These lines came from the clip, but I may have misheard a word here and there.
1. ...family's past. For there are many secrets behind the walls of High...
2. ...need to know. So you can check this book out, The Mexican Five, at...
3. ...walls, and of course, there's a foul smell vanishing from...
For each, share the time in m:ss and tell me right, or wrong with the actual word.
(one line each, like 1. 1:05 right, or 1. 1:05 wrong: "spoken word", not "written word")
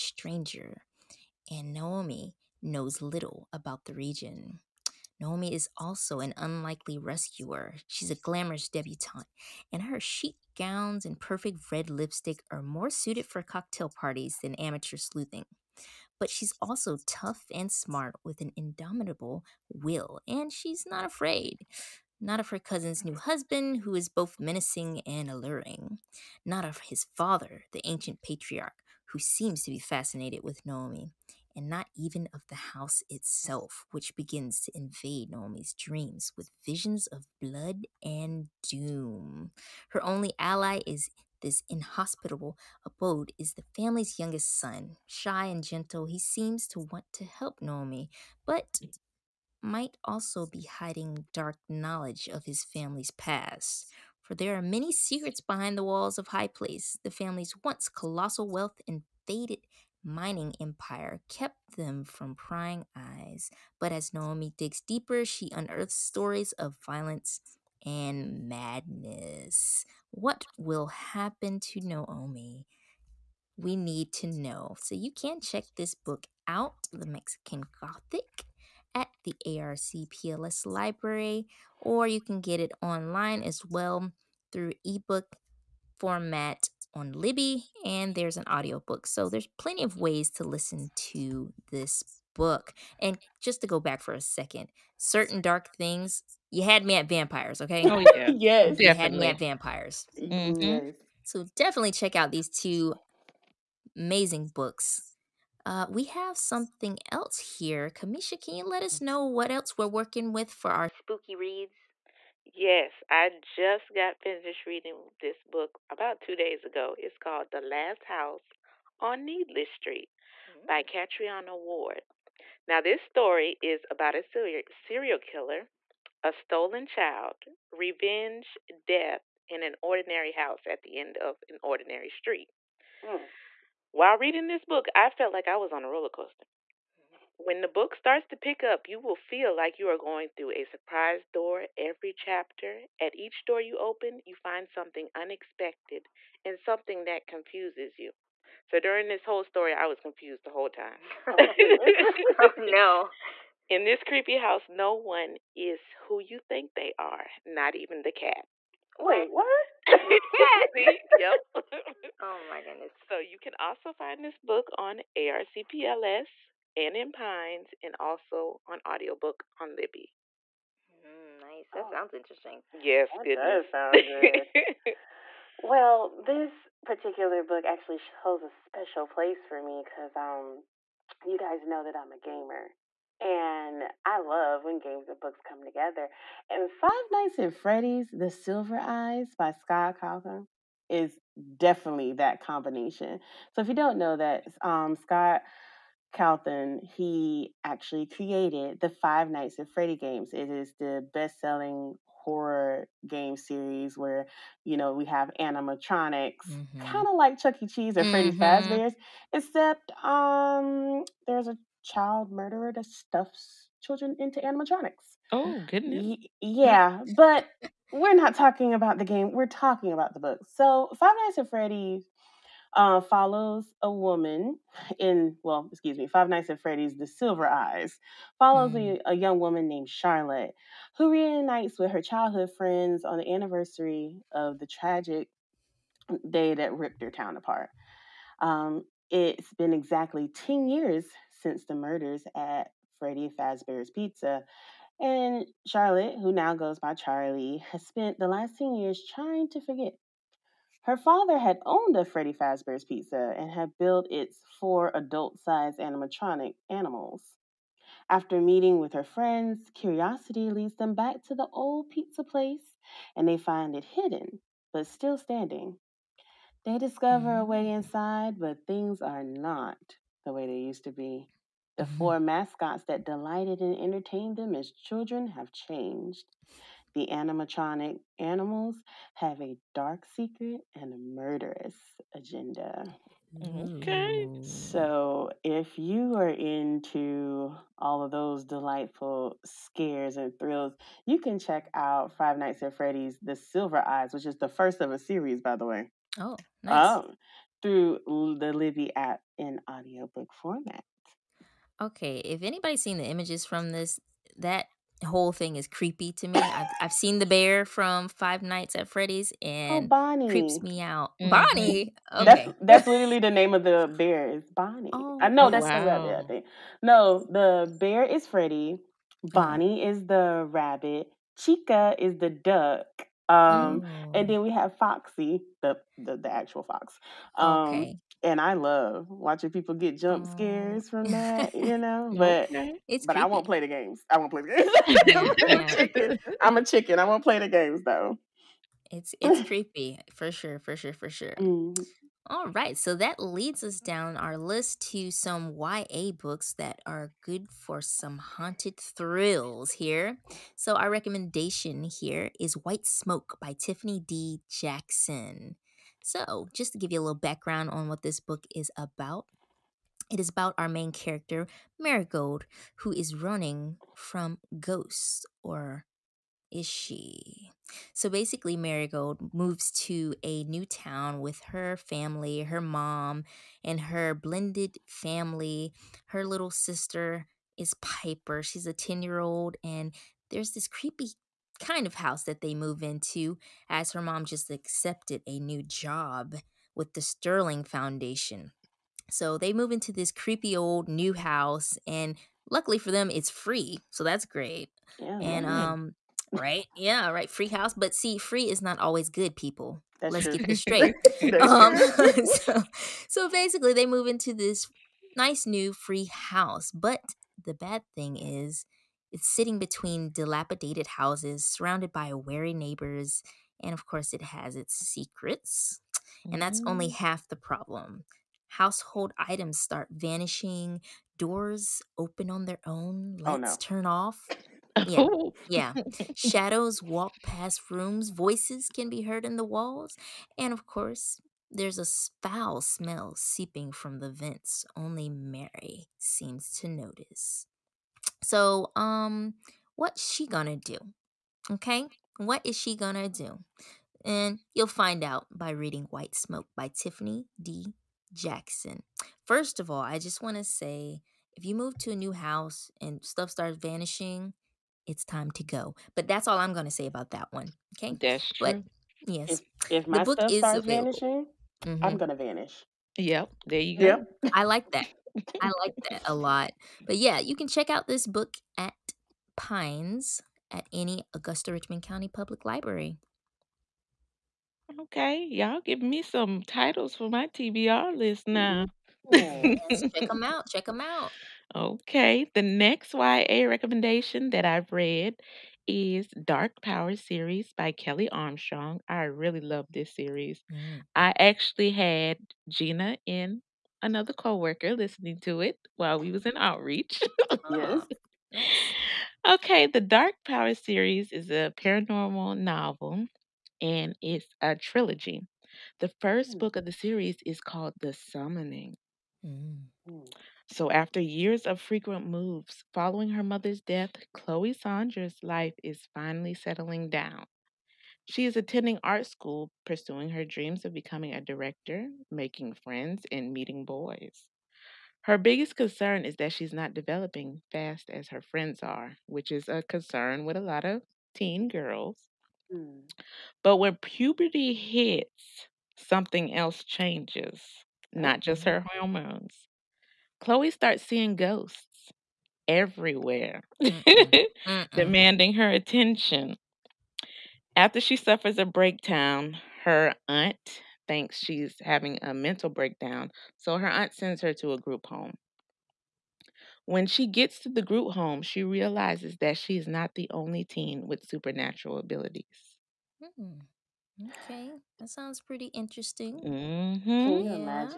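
1. 0:52 right
2. 1:13 wrong: "Gothic", not "Five"
3. 7:09 wrong: "seeping", not "vanishing".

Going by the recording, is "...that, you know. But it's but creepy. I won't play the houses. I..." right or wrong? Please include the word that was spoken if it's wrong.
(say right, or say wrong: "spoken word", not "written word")
wrong: "games", not "houses".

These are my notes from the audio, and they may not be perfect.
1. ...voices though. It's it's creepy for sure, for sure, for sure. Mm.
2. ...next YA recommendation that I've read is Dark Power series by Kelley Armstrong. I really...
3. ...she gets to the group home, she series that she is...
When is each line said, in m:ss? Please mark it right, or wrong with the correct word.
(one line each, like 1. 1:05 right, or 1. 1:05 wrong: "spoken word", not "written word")
1. 5:37 wrong: "games", not "voices"
2. 8:02 right
3. 9:16 wrong: "realizes", not "series".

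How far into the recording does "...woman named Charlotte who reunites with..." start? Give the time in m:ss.
3:49.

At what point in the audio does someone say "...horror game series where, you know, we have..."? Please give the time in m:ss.
3:22.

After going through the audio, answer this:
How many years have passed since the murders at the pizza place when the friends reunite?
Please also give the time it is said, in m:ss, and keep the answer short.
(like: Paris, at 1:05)
10, at 3:59.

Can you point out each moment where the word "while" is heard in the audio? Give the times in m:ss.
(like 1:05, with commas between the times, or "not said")
2:13, 8:15.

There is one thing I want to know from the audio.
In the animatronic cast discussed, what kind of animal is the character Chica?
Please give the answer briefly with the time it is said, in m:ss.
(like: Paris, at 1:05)
duck, at 5:22.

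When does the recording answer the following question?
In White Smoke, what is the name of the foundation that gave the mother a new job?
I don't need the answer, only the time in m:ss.
6:27.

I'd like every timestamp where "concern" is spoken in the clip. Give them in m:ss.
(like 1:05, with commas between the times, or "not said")
8:45, 8:49.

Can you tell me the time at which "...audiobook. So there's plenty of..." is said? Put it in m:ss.
1:28.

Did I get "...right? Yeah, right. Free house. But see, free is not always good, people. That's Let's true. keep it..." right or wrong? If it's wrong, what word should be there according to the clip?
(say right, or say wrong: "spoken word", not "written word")
right.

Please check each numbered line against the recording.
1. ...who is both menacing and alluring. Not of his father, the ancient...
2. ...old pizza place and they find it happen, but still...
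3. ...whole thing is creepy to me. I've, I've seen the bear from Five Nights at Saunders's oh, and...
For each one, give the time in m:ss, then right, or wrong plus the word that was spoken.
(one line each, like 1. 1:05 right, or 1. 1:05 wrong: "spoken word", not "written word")
1. 0:23 right
2. 4:21 wrong: "hidden", not "happen"
3. 5:05 wrong: "Freddy", not "Saunders".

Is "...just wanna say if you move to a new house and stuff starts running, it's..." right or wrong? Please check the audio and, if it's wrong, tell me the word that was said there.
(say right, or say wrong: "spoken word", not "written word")
wrong: "vanishing", not "running".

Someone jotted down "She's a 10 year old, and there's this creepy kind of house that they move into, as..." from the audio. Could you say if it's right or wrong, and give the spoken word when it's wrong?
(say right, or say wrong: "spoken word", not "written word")
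right.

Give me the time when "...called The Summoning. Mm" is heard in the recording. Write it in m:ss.
8:27.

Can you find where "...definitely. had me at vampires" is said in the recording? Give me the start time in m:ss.
1:38.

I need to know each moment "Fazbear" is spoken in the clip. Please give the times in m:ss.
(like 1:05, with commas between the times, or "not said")
3:28, 4:03, 4:12.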